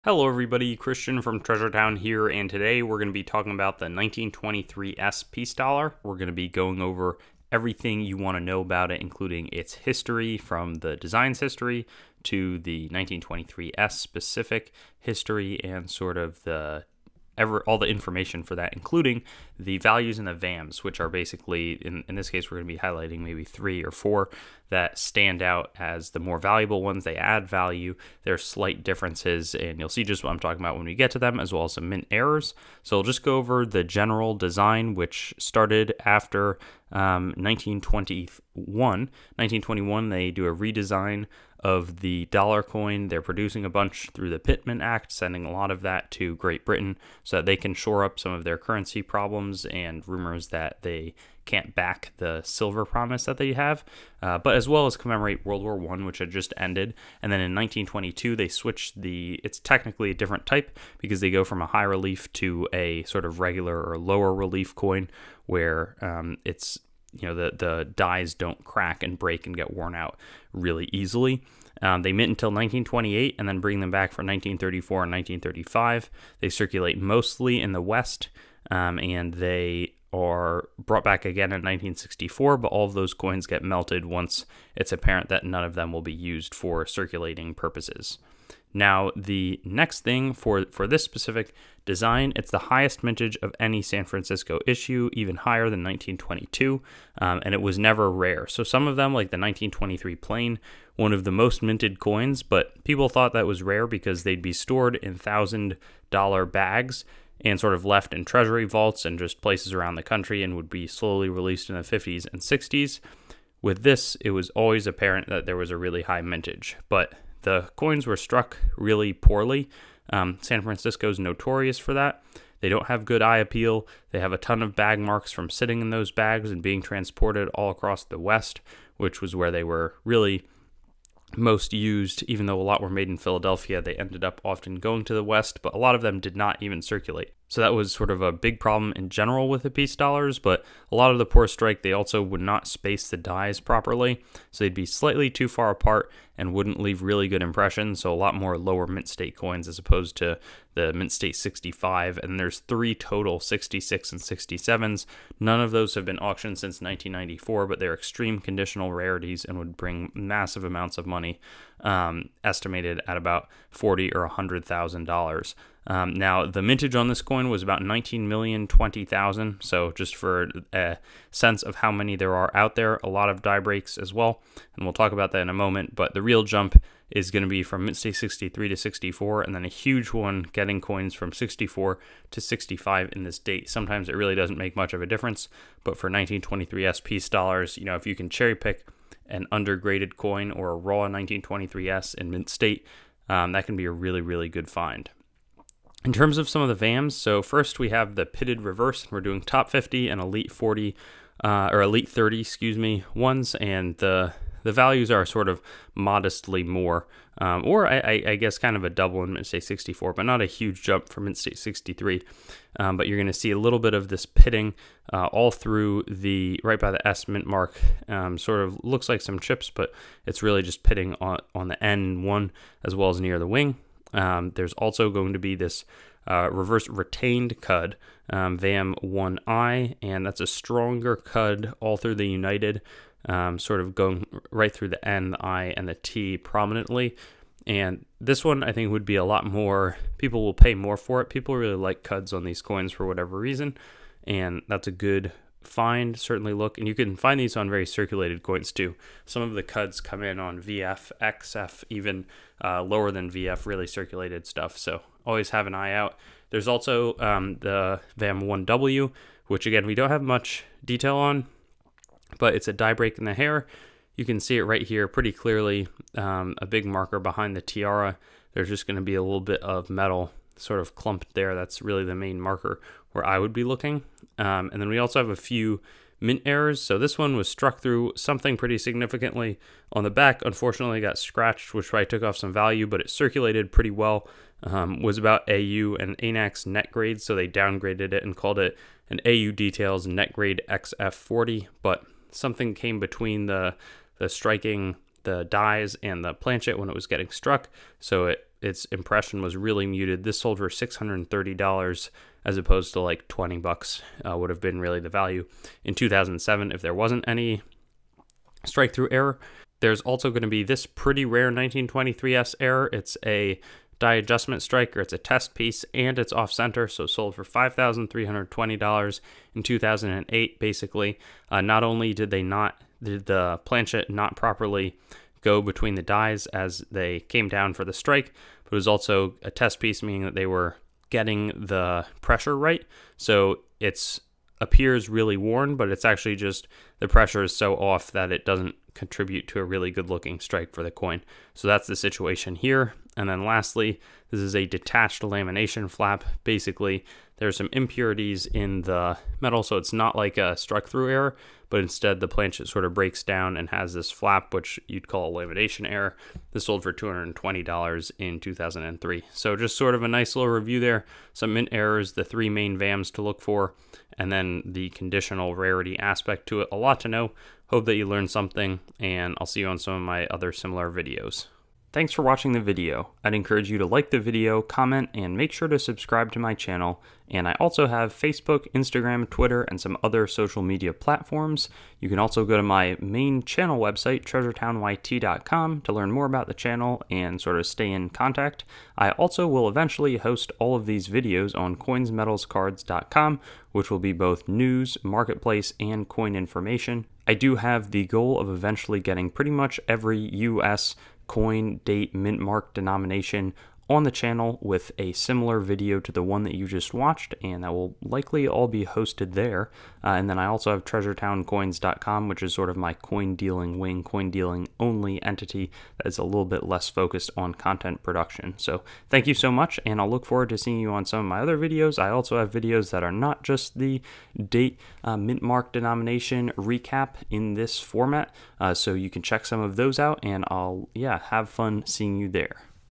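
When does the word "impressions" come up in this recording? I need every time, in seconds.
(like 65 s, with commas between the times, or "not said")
147 s, 298 s.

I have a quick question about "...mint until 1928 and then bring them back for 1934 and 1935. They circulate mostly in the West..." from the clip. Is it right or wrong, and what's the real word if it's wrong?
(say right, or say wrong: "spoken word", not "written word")
right.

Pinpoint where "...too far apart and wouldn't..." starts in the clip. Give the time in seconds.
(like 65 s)
145 s.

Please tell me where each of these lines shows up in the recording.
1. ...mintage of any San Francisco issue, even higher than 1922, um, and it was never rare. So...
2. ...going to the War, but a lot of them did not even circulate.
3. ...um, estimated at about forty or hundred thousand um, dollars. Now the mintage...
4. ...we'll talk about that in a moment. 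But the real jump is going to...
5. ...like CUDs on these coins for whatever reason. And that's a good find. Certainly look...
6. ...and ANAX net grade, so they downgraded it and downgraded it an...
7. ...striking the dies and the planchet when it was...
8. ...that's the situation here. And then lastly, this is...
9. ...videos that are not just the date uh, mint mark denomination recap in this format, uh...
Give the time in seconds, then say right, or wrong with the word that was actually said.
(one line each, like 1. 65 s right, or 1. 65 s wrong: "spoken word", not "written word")
1. 93 s right
2. 134 s wrong: "West", not "War"
3. 161 s right
4. 174 s right
5. 241 s right
6. 285 s wrong: "called", not "downgraded"
7. 294 s right
8. 341 s right
9. 422 s right.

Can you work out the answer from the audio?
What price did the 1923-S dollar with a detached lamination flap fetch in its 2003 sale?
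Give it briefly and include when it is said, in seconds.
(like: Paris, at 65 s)
$220, at 356 s.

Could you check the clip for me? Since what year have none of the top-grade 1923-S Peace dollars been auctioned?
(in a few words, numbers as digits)
1994.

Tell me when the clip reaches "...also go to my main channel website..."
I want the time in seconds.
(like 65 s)
382 s.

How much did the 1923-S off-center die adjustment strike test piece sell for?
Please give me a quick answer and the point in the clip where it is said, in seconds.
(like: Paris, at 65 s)
$5,320, at 317 s.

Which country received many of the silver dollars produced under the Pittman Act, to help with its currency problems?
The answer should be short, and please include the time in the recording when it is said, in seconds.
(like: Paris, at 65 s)
Great Britain, at 46 s.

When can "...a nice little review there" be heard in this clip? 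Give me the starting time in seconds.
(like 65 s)
360 s.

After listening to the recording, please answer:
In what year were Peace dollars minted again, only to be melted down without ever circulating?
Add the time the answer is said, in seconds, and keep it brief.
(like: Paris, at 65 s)
1964, at 81 s.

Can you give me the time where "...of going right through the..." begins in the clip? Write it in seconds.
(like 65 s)
233 s.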